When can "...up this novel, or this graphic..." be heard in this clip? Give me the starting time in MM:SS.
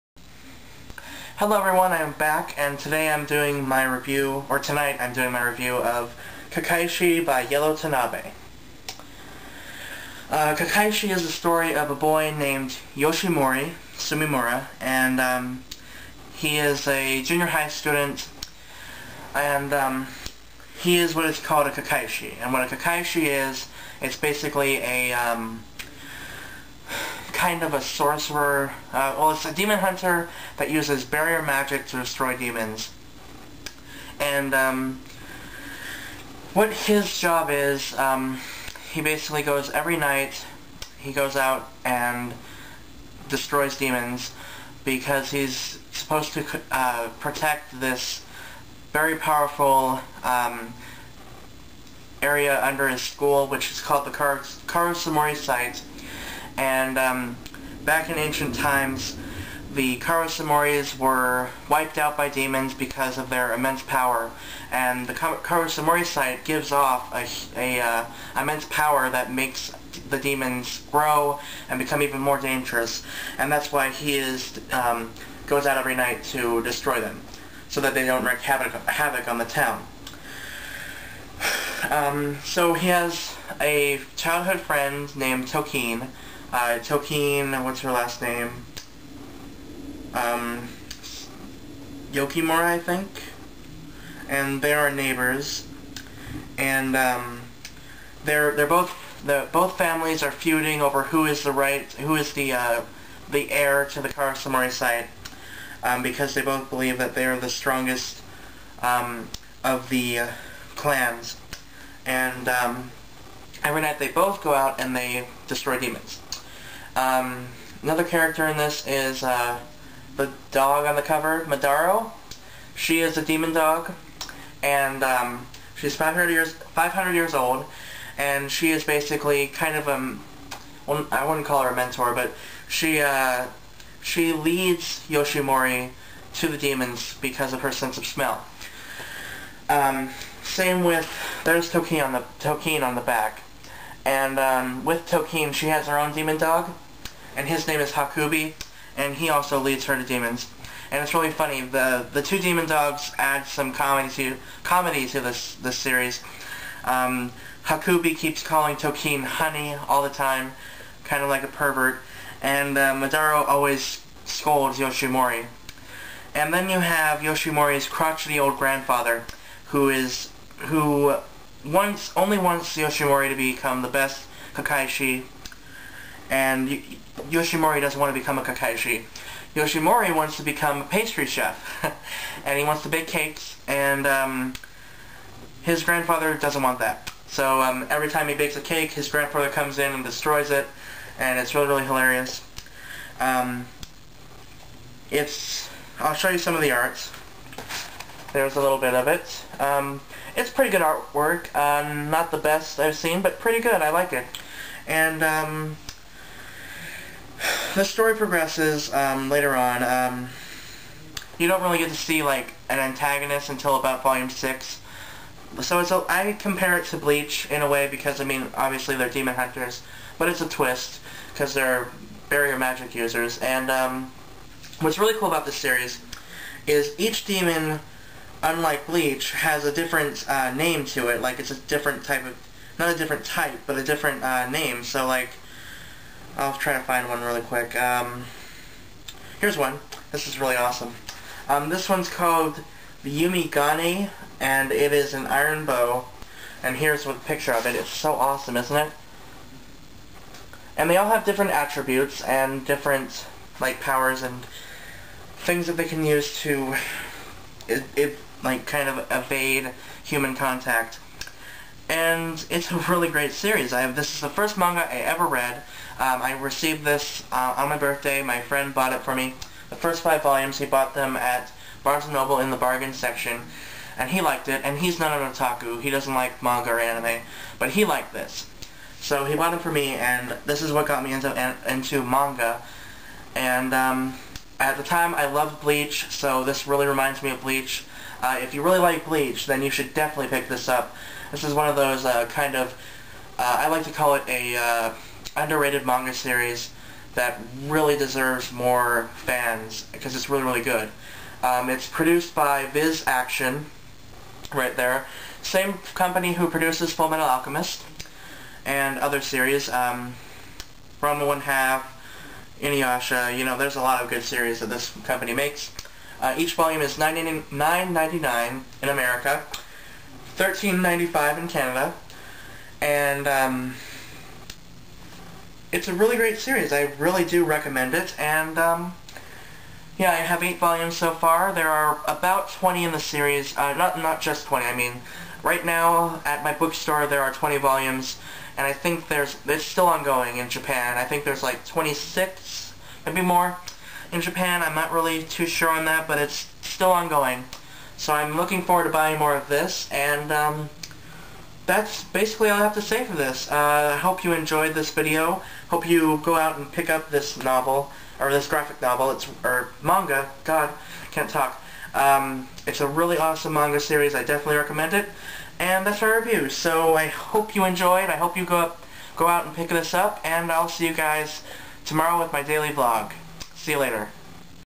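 05:56.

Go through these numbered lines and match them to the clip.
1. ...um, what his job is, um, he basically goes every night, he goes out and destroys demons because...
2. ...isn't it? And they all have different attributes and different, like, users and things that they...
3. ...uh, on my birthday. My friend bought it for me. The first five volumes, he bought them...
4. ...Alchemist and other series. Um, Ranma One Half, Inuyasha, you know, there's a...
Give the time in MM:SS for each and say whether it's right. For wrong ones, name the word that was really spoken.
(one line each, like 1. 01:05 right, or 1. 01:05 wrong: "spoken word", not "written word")
1. 00:34 right
2. 04:08 wrong: "powers", not "users"
3. 04:27 right
4. 05:07 right.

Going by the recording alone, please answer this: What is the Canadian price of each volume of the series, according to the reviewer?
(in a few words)
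$13.95.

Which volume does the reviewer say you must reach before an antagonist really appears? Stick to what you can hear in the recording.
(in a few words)
Volume 6.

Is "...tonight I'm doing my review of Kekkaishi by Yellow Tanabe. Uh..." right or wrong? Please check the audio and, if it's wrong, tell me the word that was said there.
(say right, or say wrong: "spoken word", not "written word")
right.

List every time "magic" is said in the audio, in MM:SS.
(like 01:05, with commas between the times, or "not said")
00:31, 03:42.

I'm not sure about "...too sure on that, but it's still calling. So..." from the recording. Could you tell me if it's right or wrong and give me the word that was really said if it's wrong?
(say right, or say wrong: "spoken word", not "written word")
wrong: "ongoing", not "calling".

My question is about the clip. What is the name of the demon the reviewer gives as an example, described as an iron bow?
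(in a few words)
Yumigane.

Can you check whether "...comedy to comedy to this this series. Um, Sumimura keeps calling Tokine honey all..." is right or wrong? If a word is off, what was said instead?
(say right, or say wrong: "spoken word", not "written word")
wrong: "Hakubi", not "Sumimura".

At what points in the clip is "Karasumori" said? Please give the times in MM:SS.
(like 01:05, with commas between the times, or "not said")
00:54, 00:59, 01:05, 01:44.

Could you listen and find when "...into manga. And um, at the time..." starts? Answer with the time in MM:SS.
04:41.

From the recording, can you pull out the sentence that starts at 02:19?
Um, same with there's Tokin on the Tokin on the back.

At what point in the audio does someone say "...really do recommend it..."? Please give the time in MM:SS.
05:26.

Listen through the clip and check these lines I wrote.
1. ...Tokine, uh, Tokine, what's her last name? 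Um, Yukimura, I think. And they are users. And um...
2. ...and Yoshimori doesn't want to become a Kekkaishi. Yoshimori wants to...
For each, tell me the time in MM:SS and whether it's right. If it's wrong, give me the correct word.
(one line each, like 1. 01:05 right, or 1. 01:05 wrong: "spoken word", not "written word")
1. 01:25 wrong: "neighbors", not "users"
2. 02:56 right.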